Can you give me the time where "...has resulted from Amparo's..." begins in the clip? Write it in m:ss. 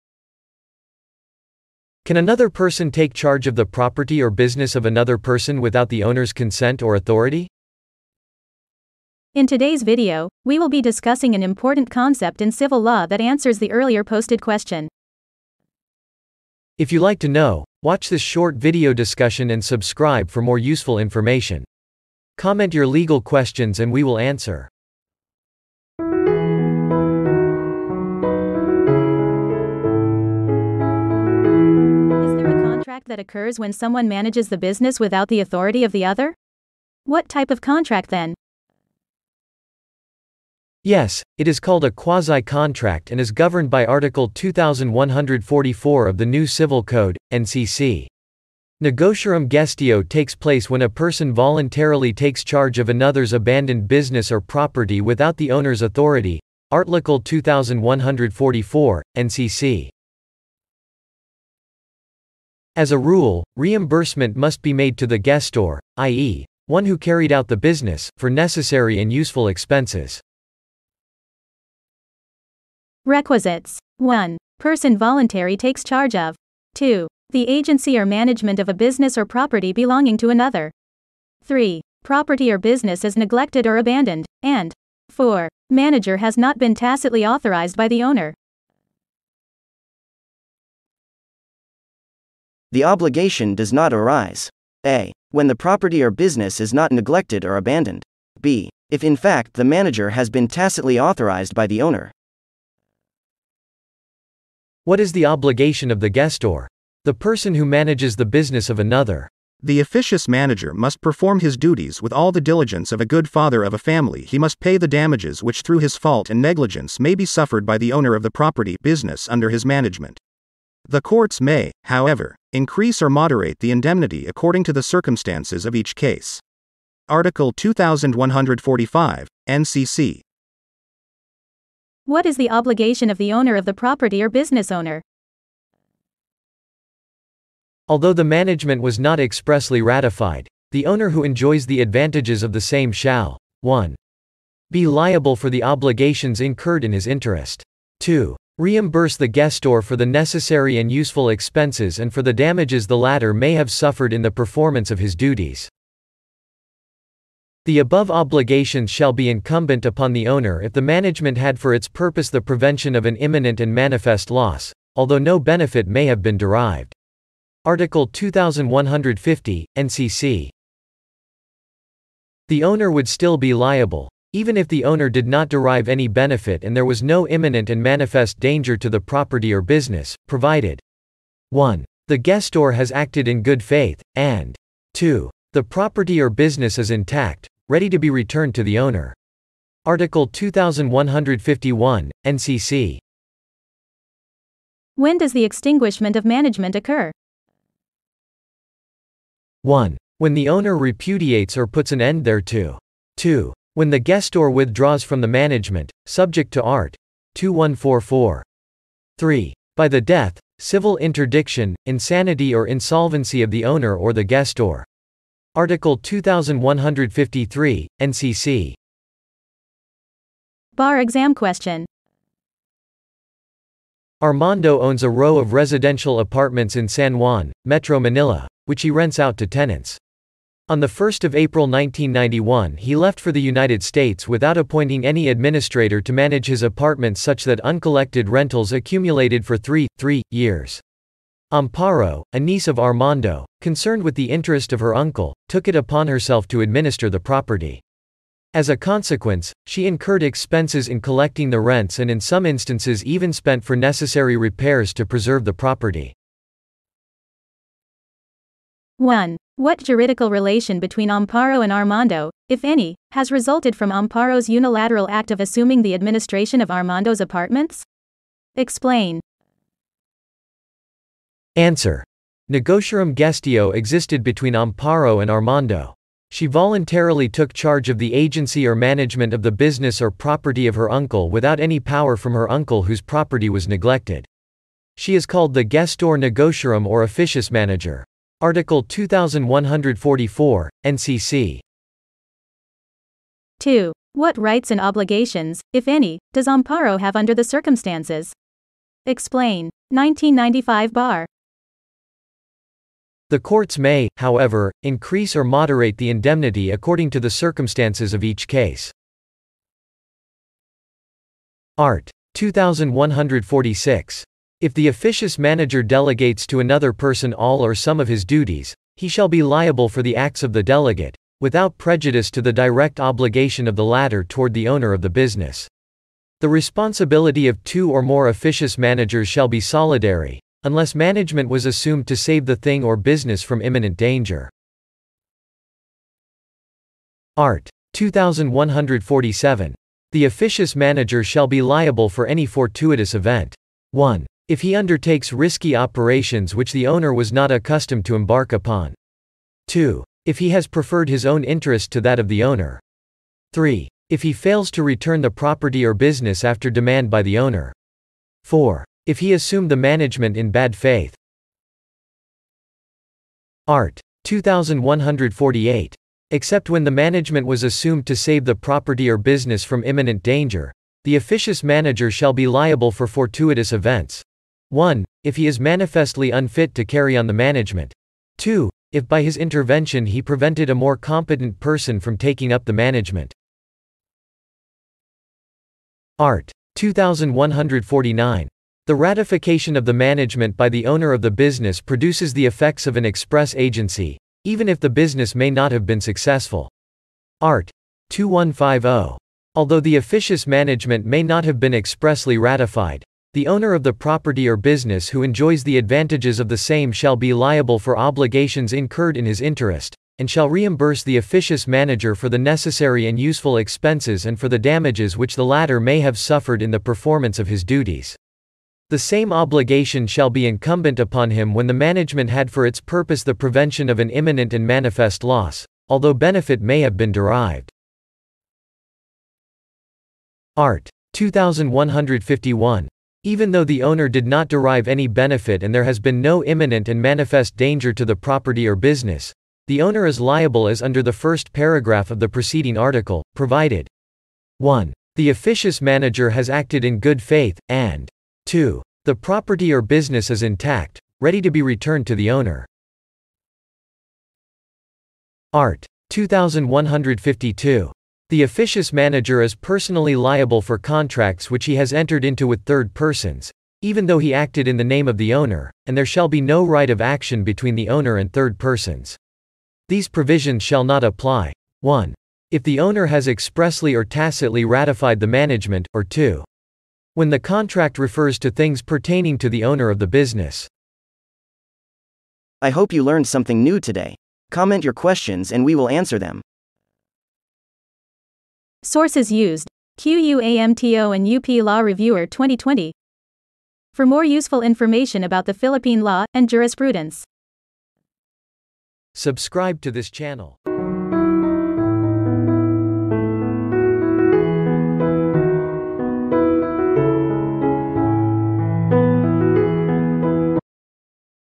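4:23.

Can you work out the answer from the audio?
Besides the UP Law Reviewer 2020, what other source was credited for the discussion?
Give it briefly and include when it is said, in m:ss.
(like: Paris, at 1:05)
QUAMTO, at 8:09.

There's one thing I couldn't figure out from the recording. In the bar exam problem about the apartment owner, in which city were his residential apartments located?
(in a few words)
San Juan.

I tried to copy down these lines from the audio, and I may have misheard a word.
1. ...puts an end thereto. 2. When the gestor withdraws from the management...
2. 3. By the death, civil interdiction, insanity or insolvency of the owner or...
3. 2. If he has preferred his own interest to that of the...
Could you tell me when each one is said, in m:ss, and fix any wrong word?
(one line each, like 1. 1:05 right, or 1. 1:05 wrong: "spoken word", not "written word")
1. 3:21 right
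2. 3:29 right
3. 5:49 right.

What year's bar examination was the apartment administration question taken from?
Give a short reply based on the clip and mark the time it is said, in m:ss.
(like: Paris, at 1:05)
1995, at 4:59.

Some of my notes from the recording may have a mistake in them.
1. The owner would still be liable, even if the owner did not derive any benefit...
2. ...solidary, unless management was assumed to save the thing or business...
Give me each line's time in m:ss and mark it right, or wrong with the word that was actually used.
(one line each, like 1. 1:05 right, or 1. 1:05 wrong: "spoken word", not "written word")
1. 2:52 right
2. 5:29 right.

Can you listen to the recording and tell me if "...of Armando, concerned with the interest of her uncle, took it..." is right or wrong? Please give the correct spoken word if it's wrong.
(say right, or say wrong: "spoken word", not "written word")
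right.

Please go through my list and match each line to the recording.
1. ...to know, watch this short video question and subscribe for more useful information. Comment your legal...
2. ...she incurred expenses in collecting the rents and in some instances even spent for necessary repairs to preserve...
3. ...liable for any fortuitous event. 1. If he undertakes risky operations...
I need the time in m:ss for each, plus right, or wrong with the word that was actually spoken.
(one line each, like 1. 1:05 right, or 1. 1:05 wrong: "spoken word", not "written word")
1. 0:17 wrong: "discussion", not "question"
2. 4:09 right
3. 5:41 right.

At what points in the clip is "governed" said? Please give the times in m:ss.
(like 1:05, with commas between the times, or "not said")
0:43.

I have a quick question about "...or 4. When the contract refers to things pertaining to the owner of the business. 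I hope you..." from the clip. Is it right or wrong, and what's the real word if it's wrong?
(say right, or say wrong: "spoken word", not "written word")
wrong: "2", not "4".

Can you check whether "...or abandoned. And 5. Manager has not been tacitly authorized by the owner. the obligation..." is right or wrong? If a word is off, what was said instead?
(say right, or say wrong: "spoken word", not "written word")
wrong: "4", not "5".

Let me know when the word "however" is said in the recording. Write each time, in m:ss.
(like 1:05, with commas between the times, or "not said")
2:01, 5:04.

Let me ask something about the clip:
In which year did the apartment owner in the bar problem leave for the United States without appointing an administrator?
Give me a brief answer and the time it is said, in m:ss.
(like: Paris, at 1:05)
1991, at 3:51.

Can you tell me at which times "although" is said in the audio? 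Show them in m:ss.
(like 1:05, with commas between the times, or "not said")
2:17, 2:44, 6:39, 7:05.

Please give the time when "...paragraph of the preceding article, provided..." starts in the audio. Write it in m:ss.
7:21.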